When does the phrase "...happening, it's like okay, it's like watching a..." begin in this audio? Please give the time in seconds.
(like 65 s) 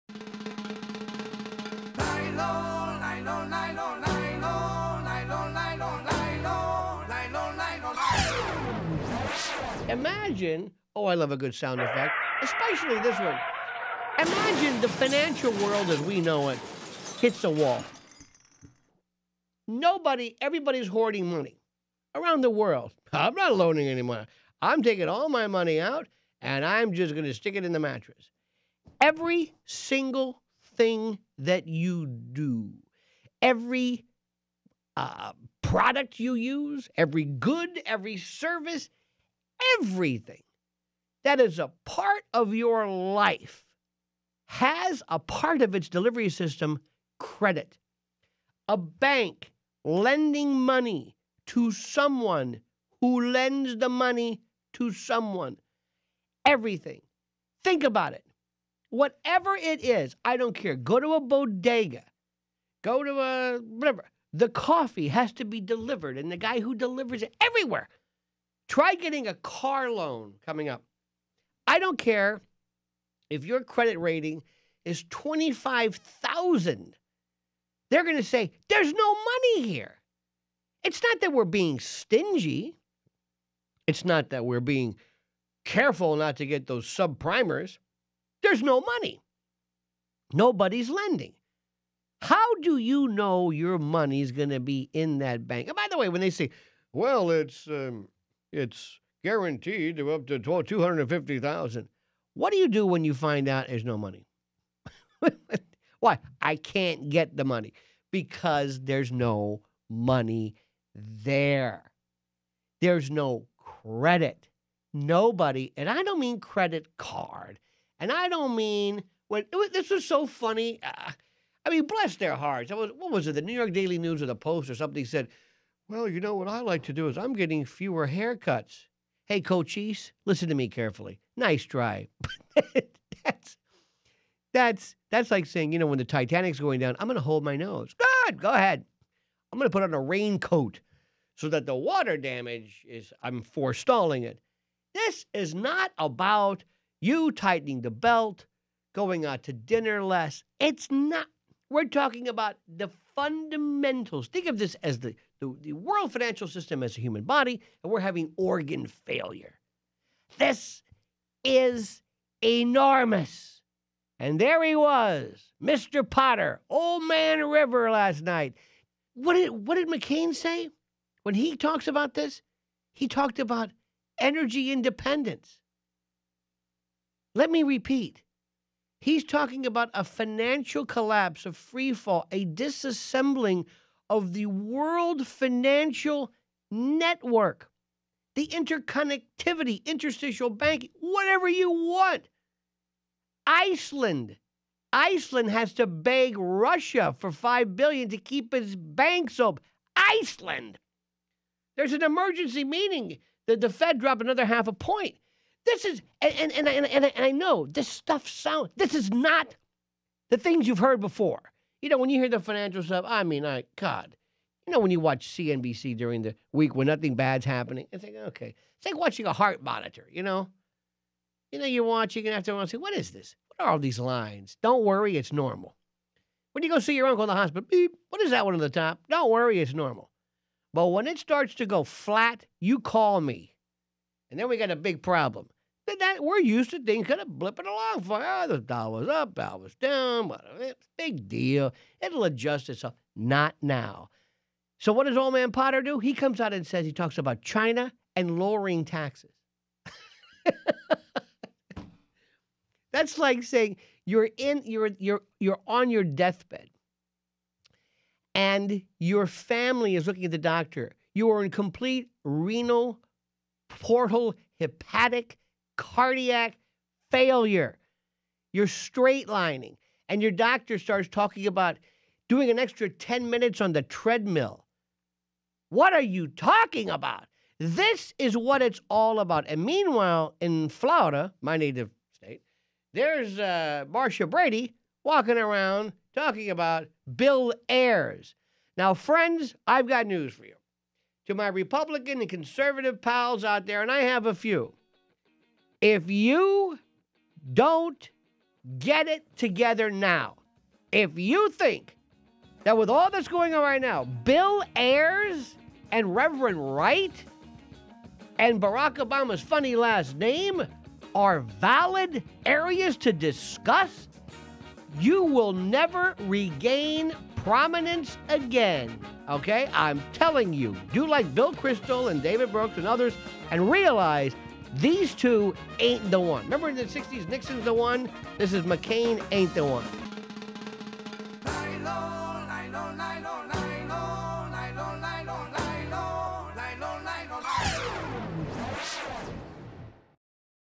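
217 s.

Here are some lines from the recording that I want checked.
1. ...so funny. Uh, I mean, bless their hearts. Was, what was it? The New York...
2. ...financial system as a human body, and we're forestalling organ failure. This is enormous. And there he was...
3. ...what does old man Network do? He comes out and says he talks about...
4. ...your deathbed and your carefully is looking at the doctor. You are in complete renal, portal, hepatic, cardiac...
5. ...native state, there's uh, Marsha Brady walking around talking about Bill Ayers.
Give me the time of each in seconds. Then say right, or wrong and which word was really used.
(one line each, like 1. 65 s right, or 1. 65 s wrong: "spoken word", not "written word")
1. 120 s right
2. 156 s wrong: "having", not "forestalling"
3. 244 s wrong: "Potter", not "Network"
4. 255 s wrong: "family", not "carefully"
5. 281 s right.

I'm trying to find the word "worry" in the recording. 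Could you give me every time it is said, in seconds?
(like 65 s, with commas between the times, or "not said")
224 s, 229 s.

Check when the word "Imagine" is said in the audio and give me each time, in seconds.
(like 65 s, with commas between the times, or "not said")
9 s, 14 s.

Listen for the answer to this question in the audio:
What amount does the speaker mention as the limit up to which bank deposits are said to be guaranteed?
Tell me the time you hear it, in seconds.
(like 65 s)
100 s.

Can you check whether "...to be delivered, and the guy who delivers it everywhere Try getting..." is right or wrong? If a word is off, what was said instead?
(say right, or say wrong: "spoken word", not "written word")
right.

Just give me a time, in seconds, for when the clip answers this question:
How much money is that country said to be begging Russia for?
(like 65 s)
197 s.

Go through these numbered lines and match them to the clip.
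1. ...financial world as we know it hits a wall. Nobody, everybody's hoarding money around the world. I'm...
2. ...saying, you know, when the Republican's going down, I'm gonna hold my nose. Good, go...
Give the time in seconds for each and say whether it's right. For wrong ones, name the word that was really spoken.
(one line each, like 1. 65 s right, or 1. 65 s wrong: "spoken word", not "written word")
1. 14 s right
2. 135 s wrong: "Titanic", not "Republican".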